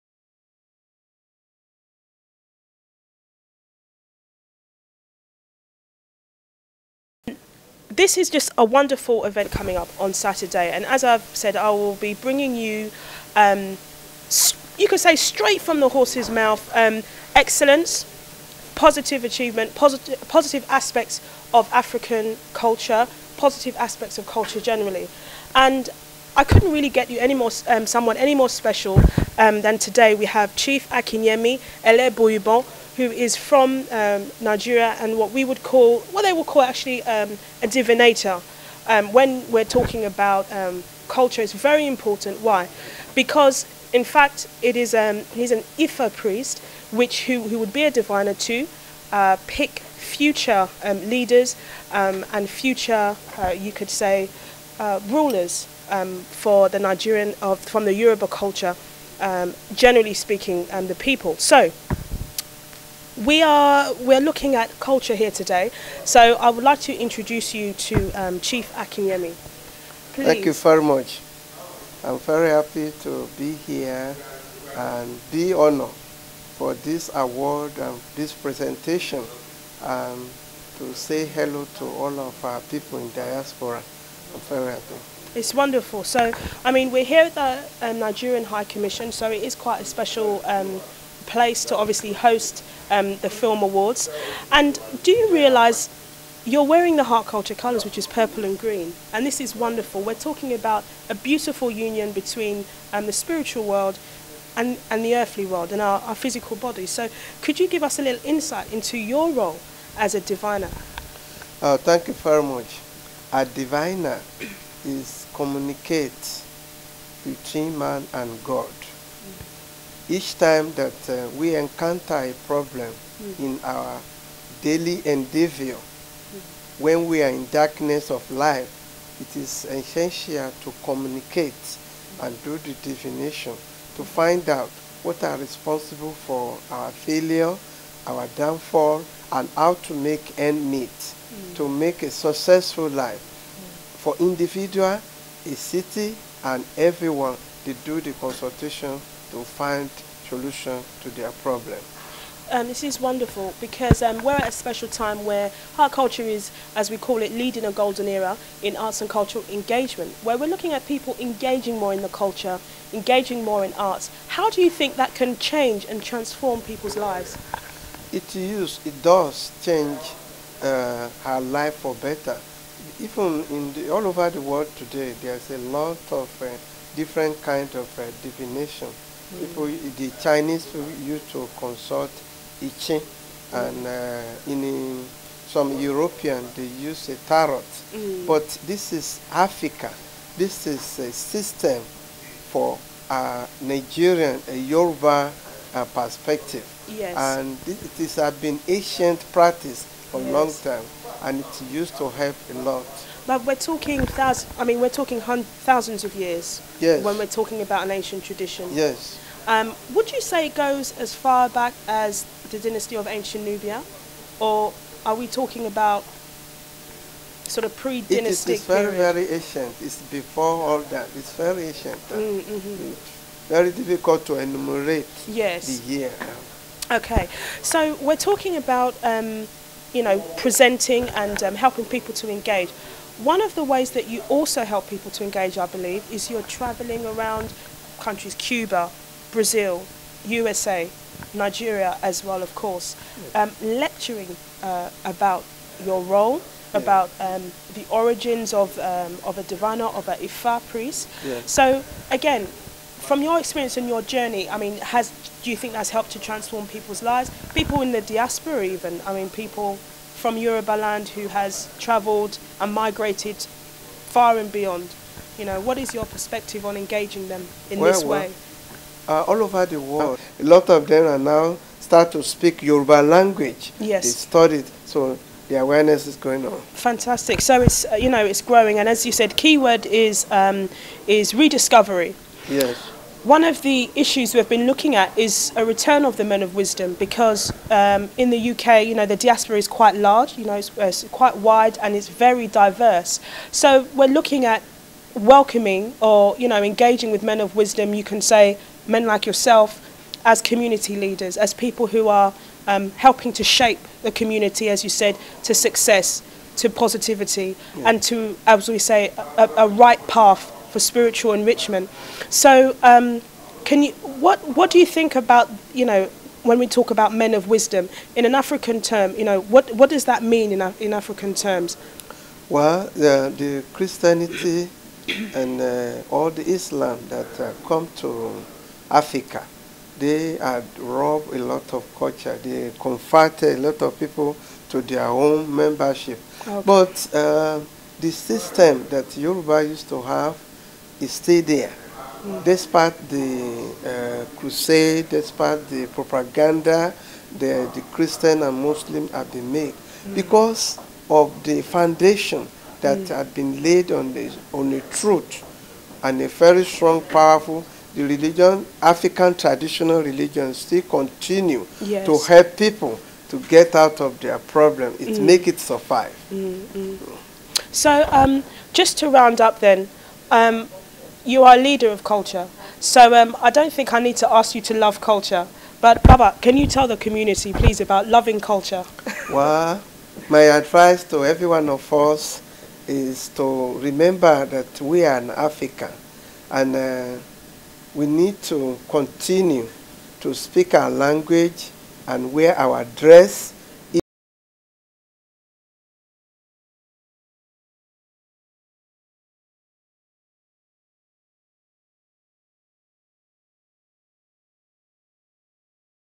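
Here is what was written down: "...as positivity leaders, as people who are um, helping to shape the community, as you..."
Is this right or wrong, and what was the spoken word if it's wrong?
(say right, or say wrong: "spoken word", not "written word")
wrong: "community", not "positivity".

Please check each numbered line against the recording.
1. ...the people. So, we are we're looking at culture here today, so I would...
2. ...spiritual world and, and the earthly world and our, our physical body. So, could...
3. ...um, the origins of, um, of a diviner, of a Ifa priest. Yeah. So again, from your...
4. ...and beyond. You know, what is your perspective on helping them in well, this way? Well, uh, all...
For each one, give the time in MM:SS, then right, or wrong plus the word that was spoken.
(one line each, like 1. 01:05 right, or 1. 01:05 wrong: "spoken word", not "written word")
1. 01:00 right
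2. 01:43 right
3. 04:07 right
4. 04:24 wrong: "engaging", not "helping".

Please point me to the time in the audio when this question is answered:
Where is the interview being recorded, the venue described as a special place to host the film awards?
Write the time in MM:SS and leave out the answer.
01:27.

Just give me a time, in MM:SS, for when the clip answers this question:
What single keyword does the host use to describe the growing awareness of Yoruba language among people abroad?
04:41.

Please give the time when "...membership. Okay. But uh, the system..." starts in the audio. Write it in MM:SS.
05:35.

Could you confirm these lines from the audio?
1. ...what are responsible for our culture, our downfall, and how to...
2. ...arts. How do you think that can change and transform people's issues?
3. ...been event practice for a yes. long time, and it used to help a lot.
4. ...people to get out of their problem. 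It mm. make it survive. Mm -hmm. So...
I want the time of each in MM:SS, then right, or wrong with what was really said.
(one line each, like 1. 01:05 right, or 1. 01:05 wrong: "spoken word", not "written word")
1. 02:15 wrong: "failure", not "culture"
2. 02:43 wrong: "lives", not "issues"
3. 03:18 wrong: "ancient", not "event"
4. 06:02 right.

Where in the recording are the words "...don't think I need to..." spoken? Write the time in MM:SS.
06:13.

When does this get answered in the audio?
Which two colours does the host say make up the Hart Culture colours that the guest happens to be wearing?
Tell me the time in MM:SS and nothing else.
01:38.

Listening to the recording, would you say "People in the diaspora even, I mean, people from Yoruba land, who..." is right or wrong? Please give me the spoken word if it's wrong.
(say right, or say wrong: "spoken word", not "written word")
right.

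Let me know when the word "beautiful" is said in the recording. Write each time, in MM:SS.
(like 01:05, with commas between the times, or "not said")
01:41.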